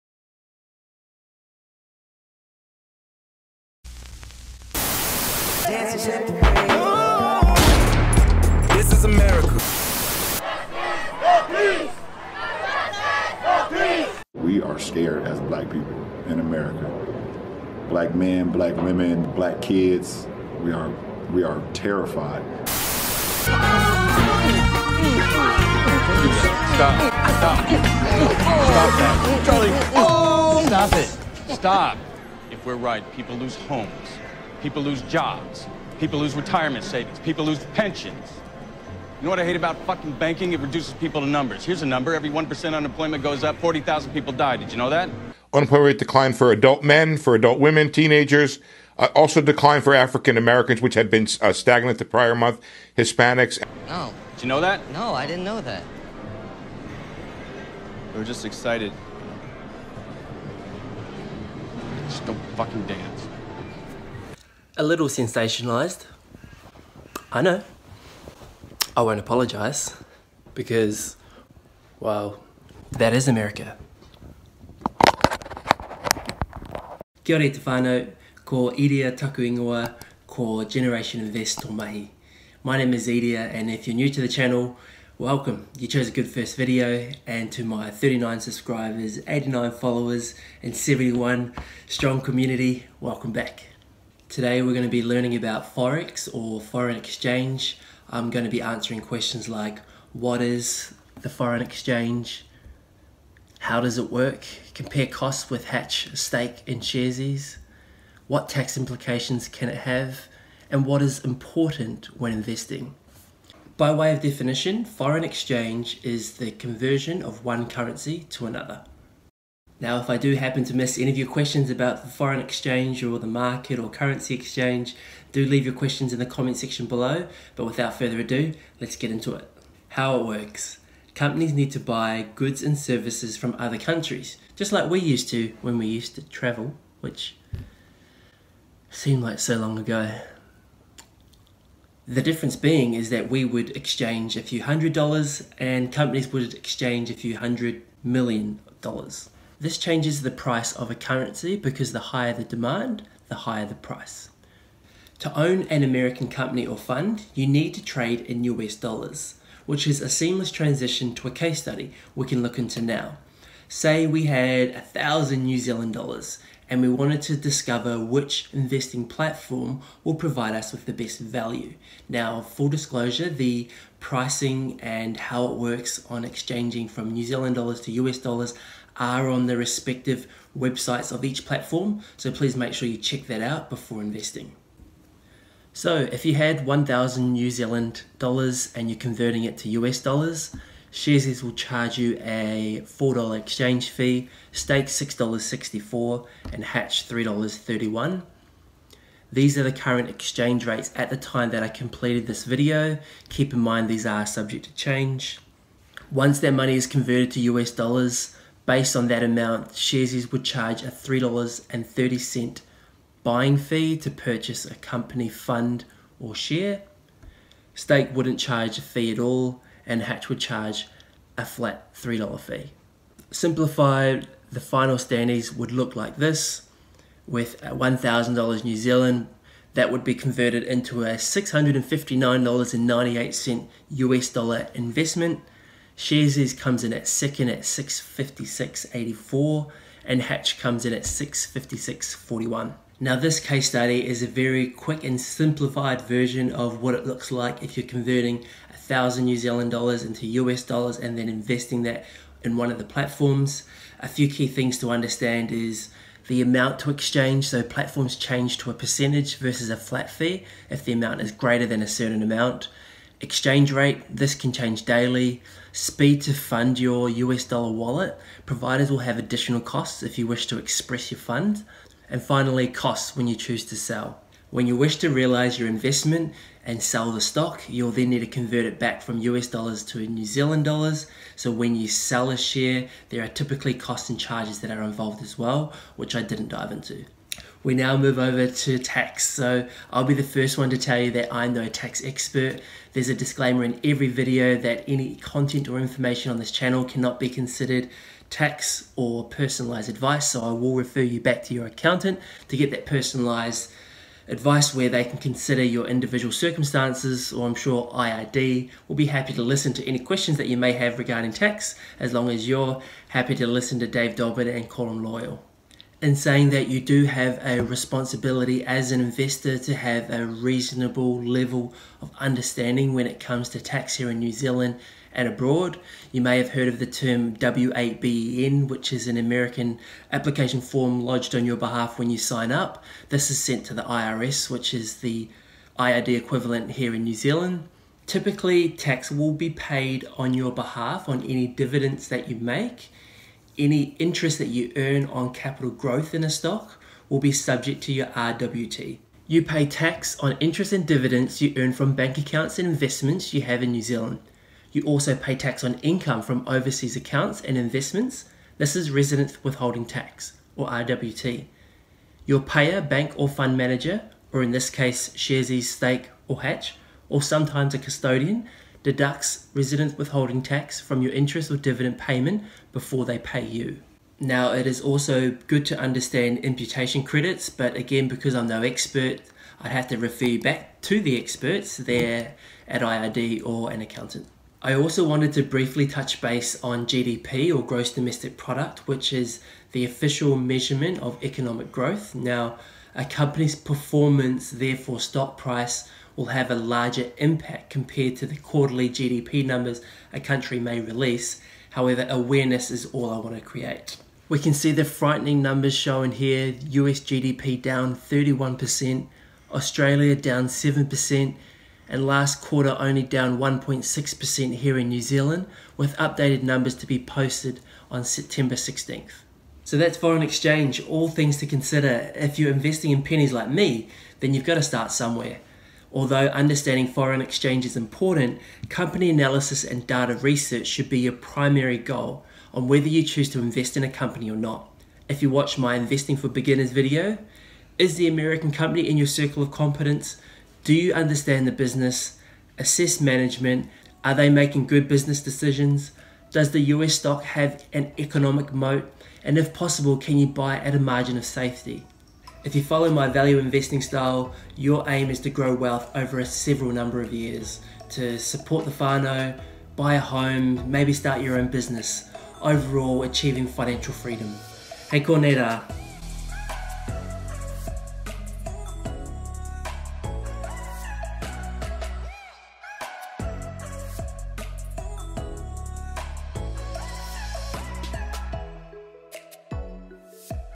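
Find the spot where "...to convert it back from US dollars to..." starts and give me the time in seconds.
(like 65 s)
278 s.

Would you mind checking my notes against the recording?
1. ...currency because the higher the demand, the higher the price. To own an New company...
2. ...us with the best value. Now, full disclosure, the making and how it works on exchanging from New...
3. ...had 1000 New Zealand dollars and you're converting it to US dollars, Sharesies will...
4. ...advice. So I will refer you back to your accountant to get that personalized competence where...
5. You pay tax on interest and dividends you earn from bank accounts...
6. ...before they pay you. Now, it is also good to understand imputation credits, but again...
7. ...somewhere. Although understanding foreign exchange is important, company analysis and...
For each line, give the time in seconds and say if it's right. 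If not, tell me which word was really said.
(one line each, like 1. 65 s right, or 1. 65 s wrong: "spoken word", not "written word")
1. 150 s wrong: "American", not "New"
2. 170 s wrong: "pricing", not "making"
3. 186 s right
4. 299 s wrong: "advice", not "competence"
5. 349 s right
6. 372 s right
7. 424 s right.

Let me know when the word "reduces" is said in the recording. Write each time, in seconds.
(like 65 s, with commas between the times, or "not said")
40 s.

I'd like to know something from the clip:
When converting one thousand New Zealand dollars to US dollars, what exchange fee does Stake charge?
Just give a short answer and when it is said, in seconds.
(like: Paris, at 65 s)
$6.64, at 194 s.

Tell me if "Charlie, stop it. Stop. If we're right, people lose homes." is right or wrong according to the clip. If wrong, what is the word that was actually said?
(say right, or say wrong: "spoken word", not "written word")
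right.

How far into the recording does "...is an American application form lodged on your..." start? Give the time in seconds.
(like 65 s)
328 s.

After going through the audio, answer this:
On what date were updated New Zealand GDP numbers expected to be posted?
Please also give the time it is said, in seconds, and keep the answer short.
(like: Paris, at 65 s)
September 16th, at 418 s.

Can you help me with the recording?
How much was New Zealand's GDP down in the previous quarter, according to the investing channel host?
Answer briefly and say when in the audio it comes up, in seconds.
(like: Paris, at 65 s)
1.6%, at 413 s.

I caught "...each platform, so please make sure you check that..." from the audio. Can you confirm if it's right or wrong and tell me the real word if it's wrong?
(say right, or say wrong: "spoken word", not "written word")
right.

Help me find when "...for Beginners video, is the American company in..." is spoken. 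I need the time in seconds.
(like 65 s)
436 s.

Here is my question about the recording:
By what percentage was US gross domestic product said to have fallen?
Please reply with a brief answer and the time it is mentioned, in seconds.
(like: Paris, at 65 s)
31%, at 406 s.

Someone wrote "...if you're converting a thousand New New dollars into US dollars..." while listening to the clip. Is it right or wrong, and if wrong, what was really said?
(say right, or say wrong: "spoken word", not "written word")
wrong: "Zealand", not "New".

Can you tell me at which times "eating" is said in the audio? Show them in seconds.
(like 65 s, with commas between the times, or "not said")
not said.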